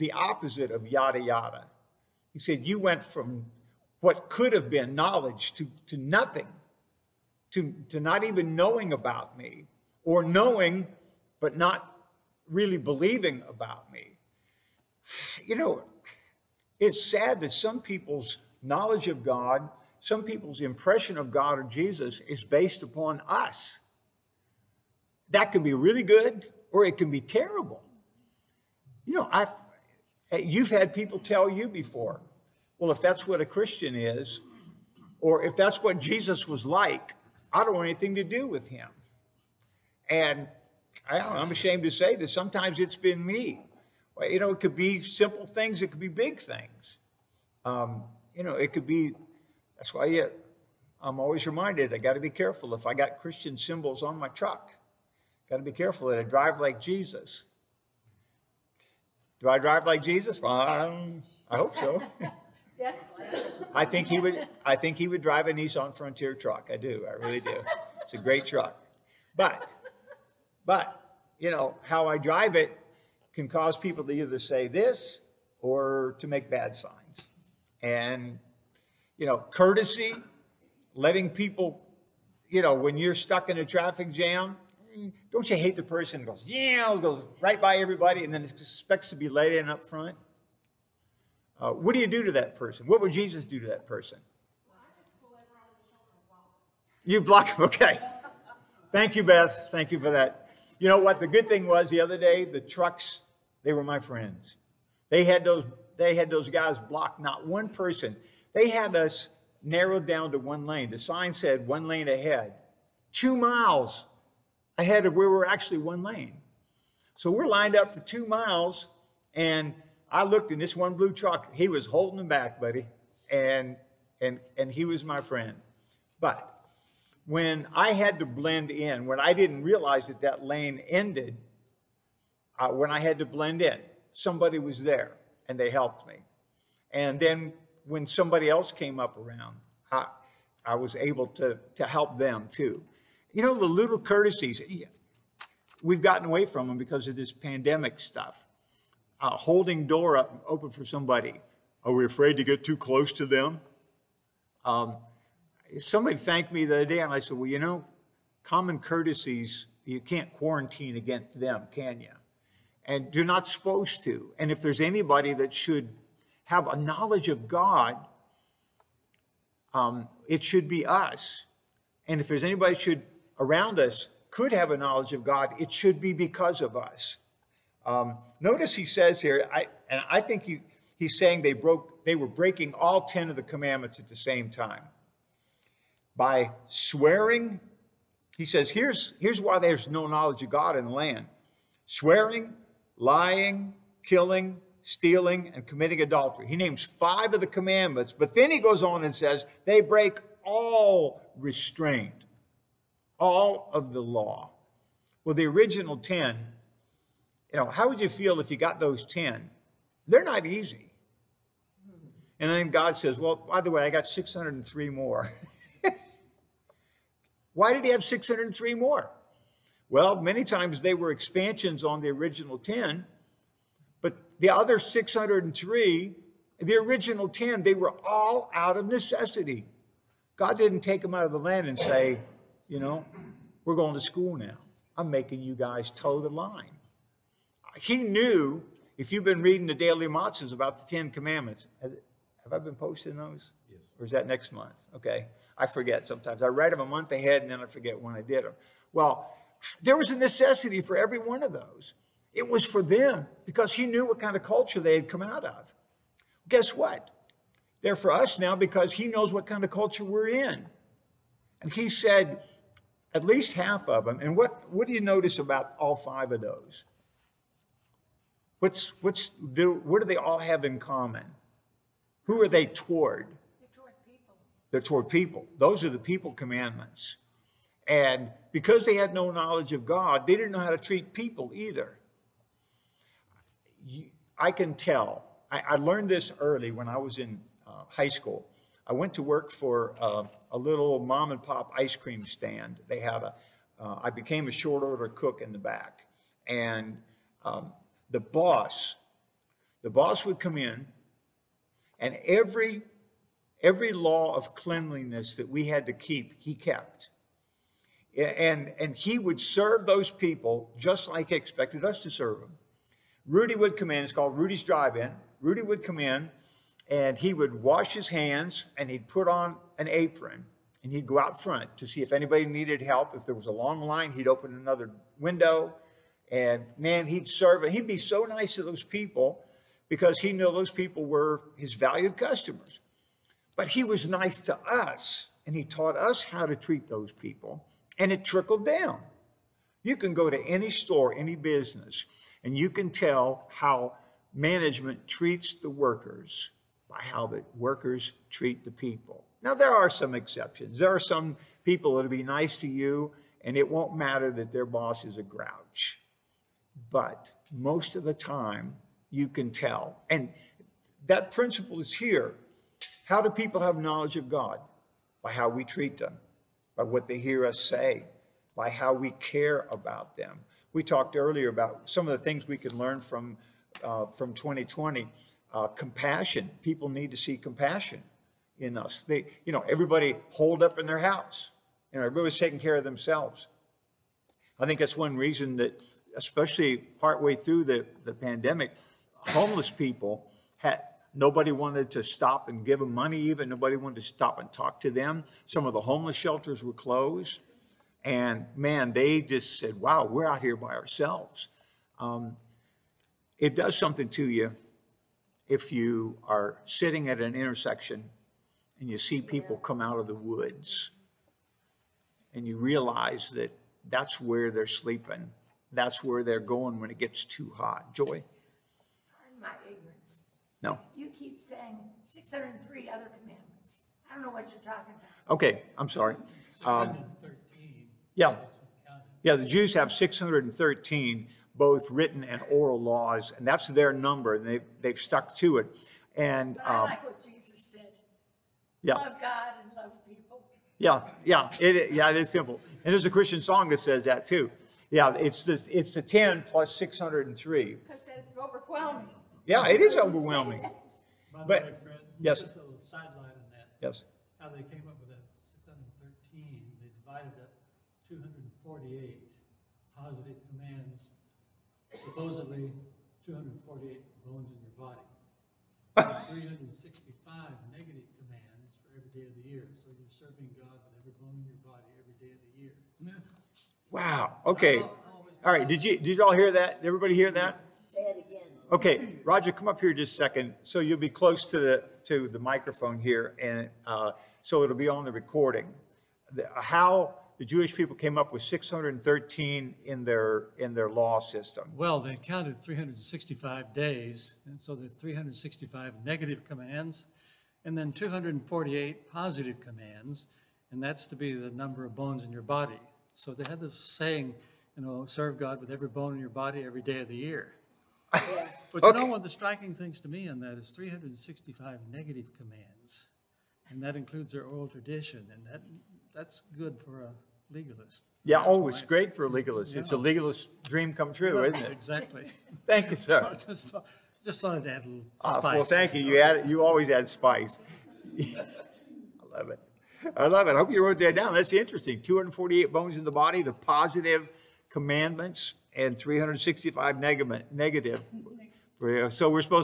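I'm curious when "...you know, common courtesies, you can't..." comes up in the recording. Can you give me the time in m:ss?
2:37.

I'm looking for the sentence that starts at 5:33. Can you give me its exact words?
But he was nice to us and he taught us how to treat those people and it trickled down.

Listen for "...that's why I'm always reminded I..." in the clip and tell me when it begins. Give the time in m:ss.
0:49.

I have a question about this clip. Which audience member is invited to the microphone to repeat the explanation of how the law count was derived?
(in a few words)
Roger.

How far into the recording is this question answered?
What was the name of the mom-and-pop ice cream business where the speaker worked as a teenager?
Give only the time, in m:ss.
5:14.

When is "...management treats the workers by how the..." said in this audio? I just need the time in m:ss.
5:44.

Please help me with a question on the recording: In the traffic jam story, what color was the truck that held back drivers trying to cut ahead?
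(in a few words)
Blue.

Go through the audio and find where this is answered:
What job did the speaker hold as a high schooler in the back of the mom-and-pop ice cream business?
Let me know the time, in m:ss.
4:54.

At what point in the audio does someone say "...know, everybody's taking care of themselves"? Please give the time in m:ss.
6:21.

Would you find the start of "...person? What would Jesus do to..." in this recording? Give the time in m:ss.
1:32.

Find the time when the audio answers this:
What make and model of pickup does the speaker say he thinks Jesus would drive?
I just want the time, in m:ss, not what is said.
1:05.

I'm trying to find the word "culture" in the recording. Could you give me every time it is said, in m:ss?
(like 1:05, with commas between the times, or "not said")
4:14, 4:19.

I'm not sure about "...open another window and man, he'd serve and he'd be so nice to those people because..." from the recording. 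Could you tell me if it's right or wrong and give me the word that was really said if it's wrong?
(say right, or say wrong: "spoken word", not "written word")
right.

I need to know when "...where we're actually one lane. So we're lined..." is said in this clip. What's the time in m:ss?
1:55.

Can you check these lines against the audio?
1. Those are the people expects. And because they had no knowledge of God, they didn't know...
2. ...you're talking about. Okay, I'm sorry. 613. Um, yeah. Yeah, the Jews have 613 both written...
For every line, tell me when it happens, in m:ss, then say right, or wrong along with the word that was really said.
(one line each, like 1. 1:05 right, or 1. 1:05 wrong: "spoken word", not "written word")
1. 4:35 wrong: "commandments", not "expects"
2. 7:04 right.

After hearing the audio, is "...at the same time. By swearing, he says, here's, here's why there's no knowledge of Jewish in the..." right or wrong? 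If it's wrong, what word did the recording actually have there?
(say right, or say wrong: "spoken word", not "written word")
wrong: "God", not "Jewish".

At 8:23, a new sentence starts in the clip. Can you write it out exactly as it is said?
So they had this saying, you know, serve God with every bone in your body every day of the year.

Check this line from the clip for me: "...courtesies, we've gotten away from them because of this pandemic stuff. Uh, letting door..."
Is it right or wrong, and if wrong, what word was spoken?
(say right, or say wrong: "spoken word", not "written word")
wrong: "holding", not "letting".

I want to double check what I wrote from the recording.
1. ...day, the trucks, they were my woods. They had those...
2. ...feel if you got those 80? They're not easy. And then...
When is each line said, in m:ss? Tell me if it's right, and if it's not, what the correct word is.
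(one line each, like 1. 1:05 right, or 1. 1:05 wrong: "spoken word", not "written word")
1. 1:42 wrong: "friends", not "woods"
2. 3:28 wrong: "10", not "80".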